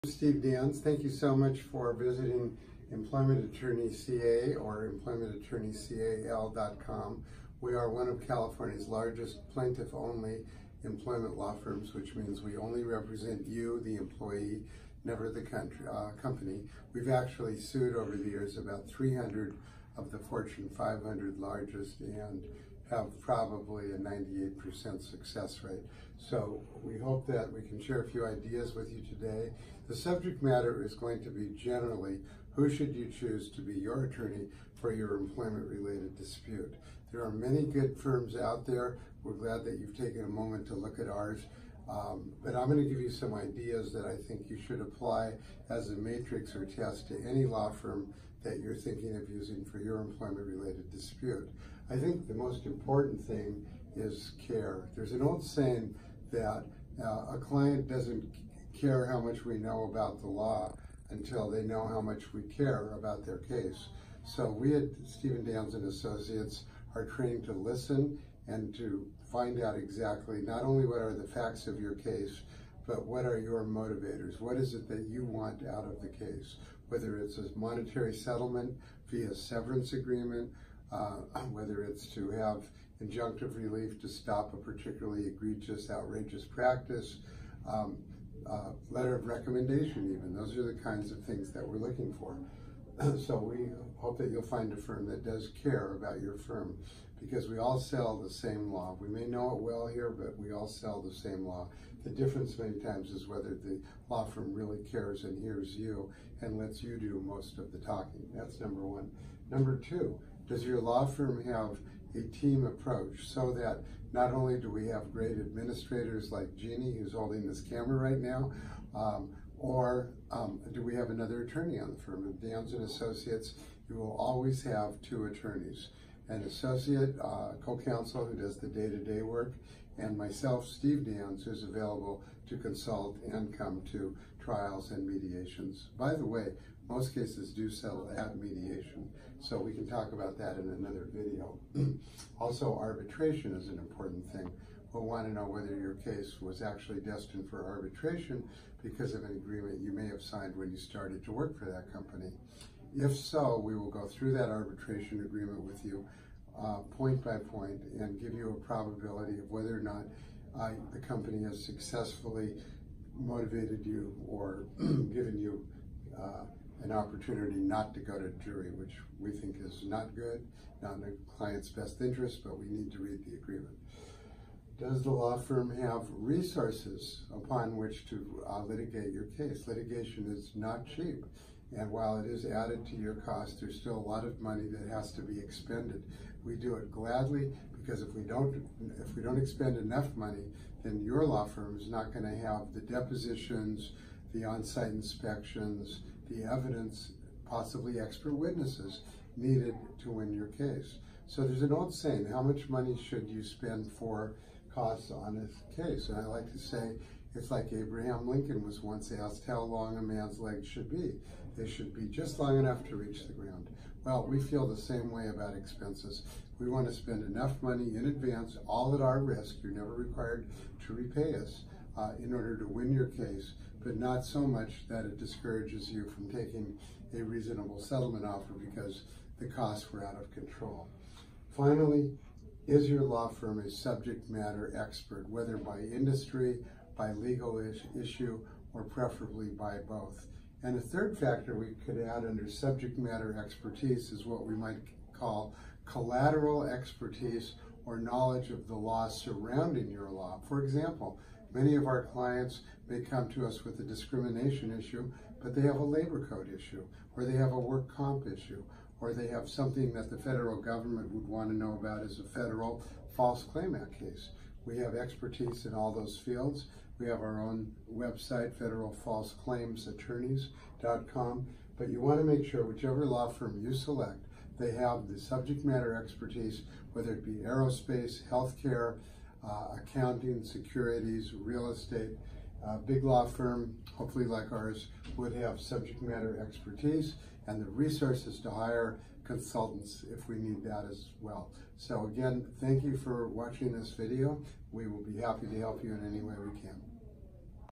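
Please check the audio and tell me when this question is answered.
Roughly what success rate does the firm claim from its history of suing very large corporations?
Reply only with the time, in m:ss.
0:23.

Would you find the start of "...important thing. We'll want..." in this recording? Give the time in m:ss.
2:23.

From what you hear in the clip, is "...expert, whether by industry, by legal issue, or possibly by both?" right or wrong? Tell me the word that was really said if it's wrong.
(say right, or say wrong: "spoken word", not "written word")
wrong: "preferably", not "possibly".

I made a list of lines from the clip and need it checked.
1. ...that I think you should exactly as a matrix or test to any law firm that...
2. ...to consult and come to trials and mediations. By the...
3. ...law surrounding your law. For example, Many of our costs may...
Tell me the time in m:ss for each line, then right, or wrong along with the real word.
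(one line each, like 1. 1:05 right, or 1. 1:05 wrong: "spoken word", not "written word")
1. 0:43 wrong: "apply", not "exactly"
2. 2:12 right
3. 4:08 wrong: "clients", not "costs".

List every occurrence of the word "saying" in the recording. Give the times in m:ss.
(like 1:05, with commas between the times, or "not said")
0:55, 3:21.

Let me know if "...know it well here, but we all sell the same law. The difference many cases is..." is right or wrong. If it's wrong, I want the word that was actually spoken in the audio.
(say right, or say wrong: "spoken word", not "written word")
wrong: "times", not "cases".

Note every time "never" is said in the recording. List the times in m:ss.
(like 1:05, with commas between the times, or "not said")
0:15, 3:39.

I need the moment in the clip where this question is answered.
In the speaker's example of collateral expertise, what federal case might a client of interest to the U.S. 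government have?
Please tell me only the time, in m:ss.
4:23.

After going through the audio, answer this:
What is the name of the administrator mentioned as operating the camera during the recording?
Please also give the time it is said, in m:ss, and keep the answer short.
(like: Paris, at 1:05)
Jeannie, at 1:56.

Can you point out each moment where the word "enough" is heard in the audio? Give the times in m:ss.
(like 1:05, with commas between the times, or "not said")
3:09, 3:32, 3:37.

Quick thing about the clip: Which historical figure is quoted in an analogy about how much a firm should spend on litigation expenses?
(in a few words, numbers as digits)
Abraham Lincoln.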